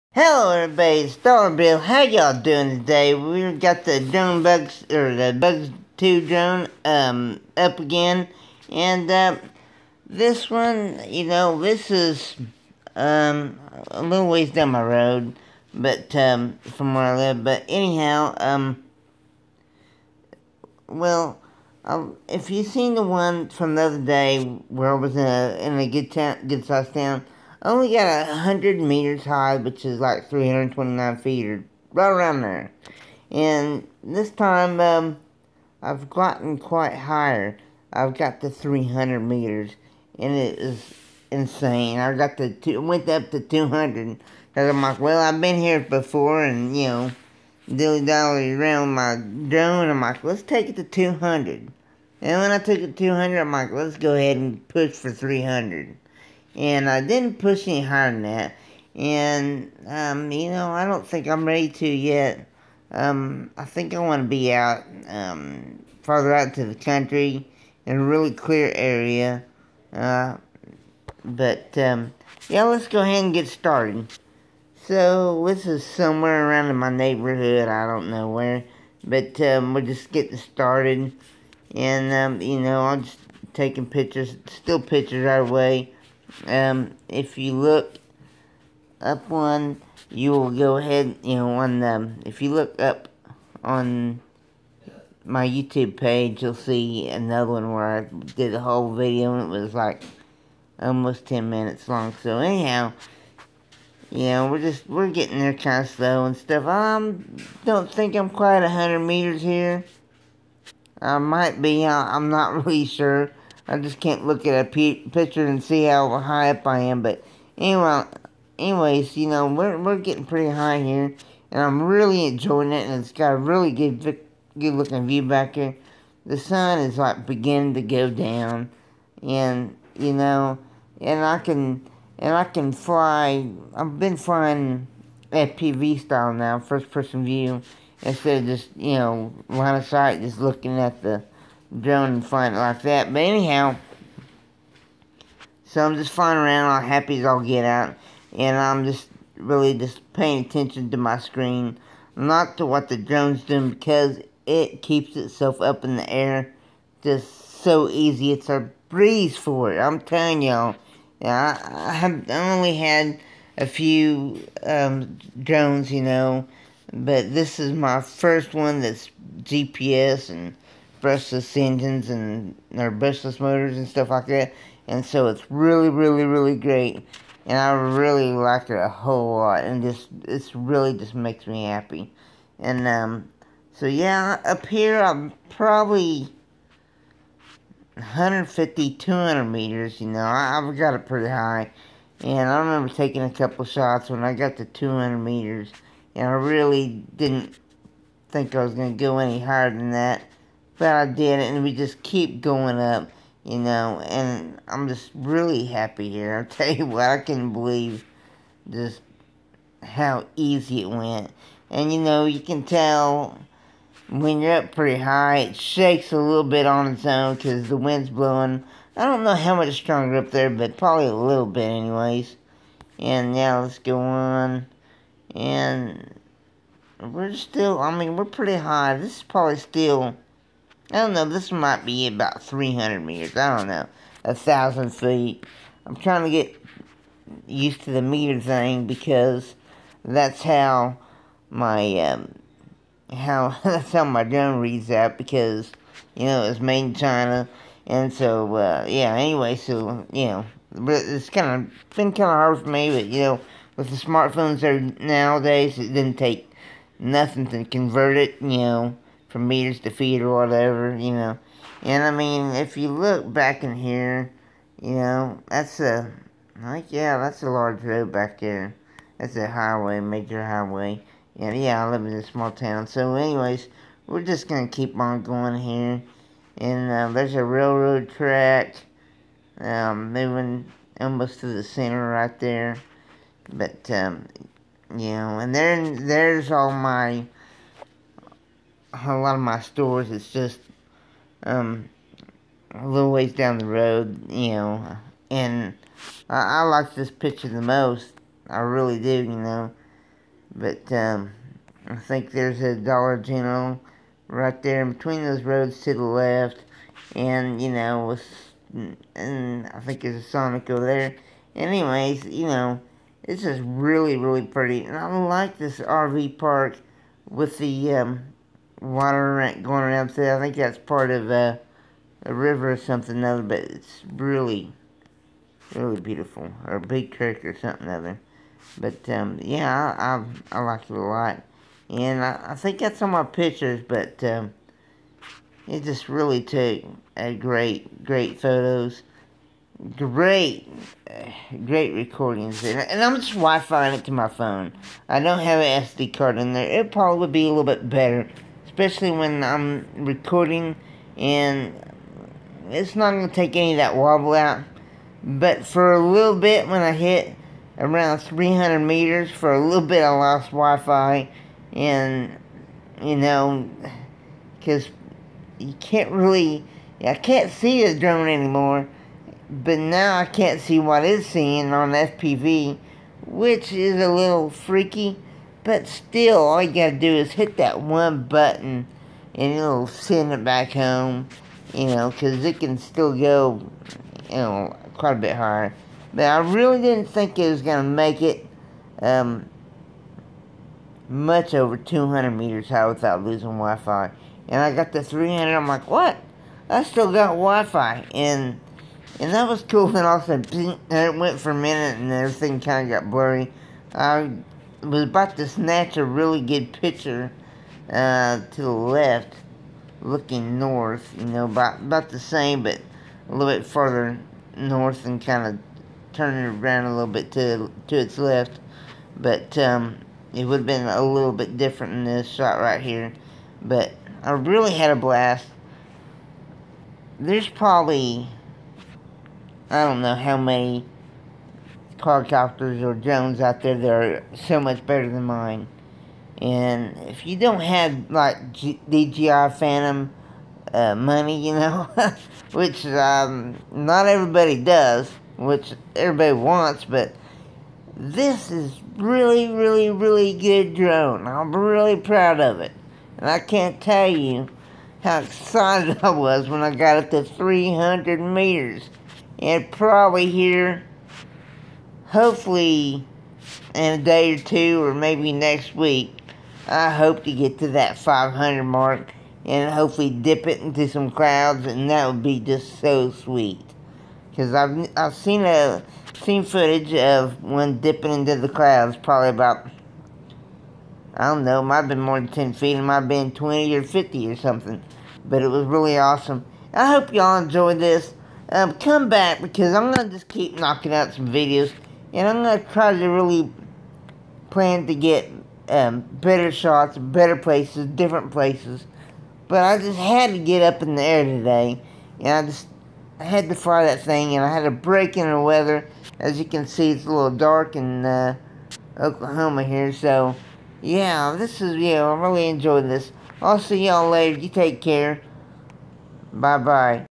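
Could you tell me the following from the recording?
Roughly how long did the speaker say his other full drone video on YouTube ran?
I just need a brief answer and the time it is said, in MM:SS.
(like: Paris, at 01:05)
almost 10 minutes, at 01:40.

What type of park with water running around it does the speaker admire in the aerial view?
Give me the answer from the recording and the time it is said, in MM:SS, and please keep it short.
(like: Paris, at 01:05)
RV park, at 05:15.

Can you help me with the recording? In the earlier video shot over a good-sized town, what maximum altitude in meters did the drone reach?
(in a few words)
100 meters.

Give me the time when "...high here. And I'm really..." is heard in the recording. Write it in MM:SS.
02:00.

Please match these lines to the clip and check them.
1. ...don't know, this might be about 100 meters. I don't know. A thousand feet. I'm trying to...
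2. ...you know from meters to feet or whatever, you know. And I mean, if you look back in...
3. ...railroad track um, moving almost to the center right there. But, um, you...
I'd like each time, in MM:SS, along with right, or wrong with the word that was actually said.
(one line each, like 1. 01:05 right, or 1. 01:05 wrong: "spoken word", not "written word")
1. 03:50 wrong: "300", not "100"
2. 04:18 right
3. 04:37 right.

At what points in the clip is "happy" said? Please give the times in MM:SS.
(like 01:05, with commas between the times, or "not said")
02:26, 03:01, 03:25.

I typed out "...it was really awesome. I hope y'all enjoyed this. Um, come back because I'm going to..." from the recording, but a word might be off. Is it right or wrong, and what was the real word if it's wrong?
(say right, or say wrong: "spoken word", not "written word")
right.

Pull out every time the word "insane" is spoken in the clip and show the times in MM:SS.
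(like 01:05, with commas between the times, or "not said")
00:41.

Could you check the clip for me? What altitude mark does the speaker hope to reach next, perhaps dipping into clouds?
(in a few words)
500.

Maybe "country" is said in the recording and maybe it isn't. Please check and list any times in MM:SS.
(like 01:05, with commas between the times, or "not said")
01:06.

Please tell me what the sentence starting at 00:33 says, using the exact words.
And this time, um, I've gotten quite higher.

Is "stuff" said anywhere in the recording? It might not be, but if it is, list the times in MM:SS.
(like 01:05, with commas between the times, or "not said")
01:46, 02:53.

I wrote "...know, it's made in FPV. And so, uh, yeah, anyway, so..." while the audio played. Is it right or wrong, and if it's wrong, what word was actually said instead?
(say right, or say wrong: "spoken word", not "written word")
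wrong: "China", not "FPV".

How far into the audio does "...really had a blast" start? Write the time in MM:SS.
07:04.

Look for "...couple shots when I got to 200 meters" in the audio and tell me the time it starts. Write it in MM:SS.
03:13.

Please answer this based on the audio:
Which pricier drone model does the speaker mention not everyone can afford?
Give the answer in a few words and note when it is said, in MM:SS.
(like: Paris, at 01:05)
DJI Phantom, at 07:18.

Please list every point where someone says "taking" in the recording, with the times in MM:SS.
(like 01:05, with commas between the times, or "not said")
01:23, 03:12.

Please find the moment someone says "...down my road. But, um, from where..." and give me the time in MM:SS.
00:14.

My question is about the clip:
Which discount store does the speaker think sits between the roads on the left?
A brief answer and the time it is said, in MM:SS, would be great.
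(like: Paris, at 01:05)
Dollar General, at 05:02.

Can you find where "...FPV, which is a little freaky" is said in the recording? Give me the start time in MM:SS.
06:11.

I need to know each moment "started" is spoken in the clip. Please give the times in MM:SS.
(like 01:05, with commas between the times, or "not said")
01:13, 01:20.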